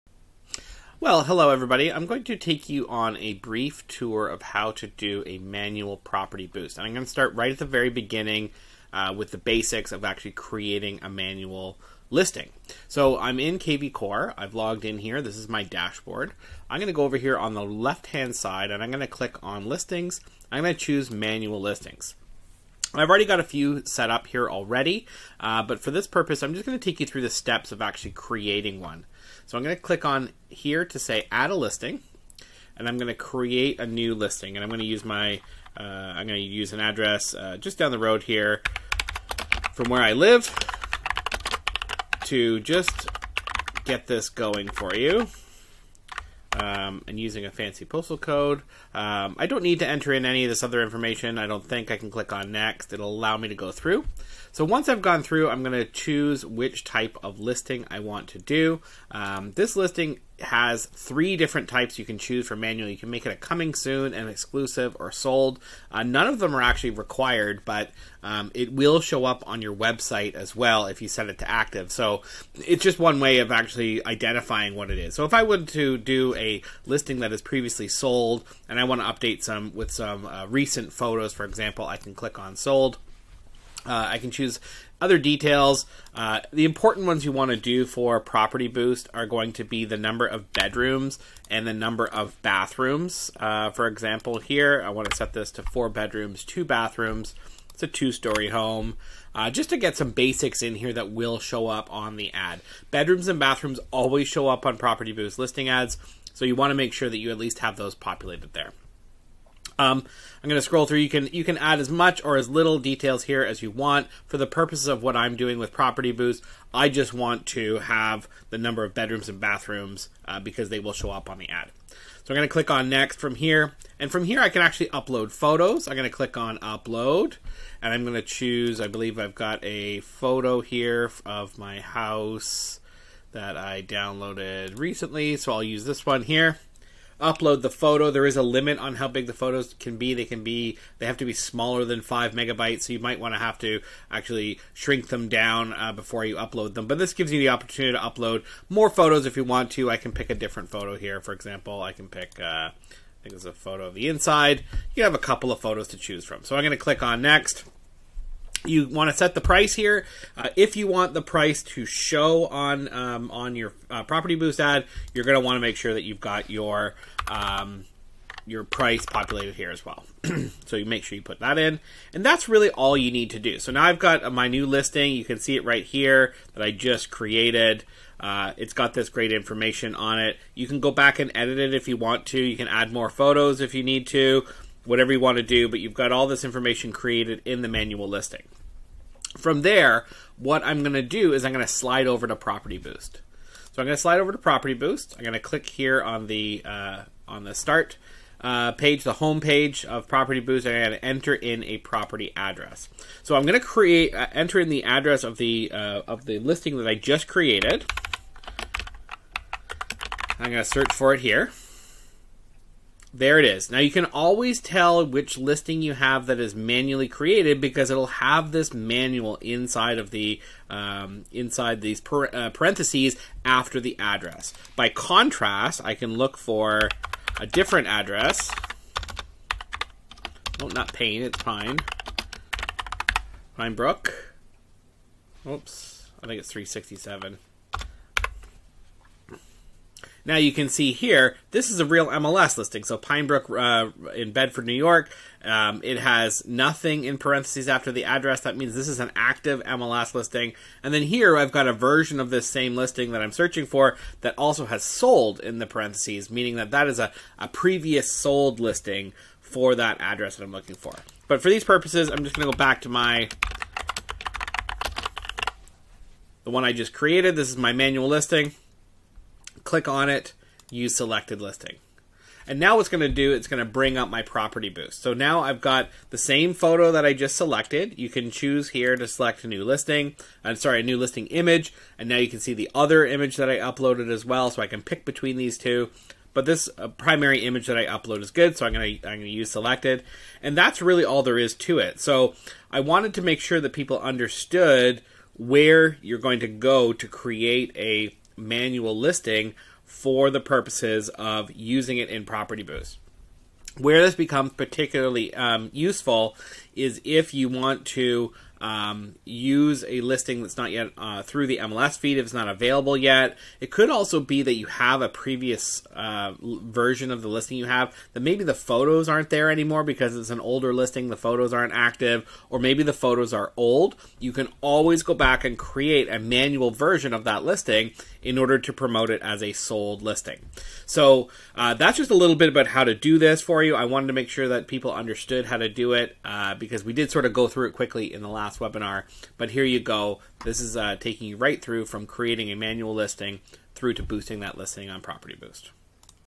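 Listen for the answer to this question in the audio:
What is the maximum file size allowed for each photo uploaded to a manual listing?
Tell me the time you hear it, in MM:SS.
02:22.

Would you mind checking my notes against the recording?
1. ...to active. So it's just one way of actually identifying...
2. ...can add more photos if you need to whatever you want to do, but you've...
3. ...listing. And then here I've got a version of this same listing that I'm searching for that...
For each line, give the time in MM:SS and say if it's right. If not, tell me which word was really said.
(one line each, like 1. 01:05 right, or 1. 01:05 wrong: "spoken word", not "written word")
1. 01:11 right
2. 03:02 right
3. 04:10 right.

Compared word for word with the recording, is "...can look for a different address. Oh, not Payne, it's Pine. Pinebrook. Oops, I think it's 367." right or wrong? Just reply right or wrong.
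right.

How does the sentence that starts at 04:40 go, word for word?
I'm uh, sorry, a new listing image.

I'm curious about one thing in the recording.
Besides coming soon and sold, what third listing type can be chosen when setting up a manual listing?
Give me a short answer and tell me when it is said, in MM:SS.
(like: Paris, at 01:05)
exclusive, at 01:04.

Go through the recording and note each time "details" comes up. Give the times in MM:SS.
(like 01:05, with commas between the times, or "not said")
01:25, 01:52.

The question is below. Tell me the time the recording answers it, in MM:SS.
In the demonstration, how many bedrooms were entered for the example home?
01:35.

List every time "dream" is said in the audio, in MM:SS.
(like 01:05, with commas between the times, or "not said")
not said.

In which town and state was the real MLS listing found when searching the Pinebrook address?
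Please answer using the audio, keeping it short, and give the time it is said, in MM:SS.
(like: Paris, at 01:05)
Bedford, New York, at 04:04.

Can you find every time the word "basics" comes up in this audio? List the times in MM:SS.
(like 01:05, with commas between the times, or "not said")
00:09, 01:40.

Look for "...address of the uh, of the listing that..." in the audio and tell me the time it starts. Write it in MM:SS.
03:24.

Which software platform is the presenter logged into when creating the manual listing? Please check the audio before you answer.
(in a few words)
kvCORE.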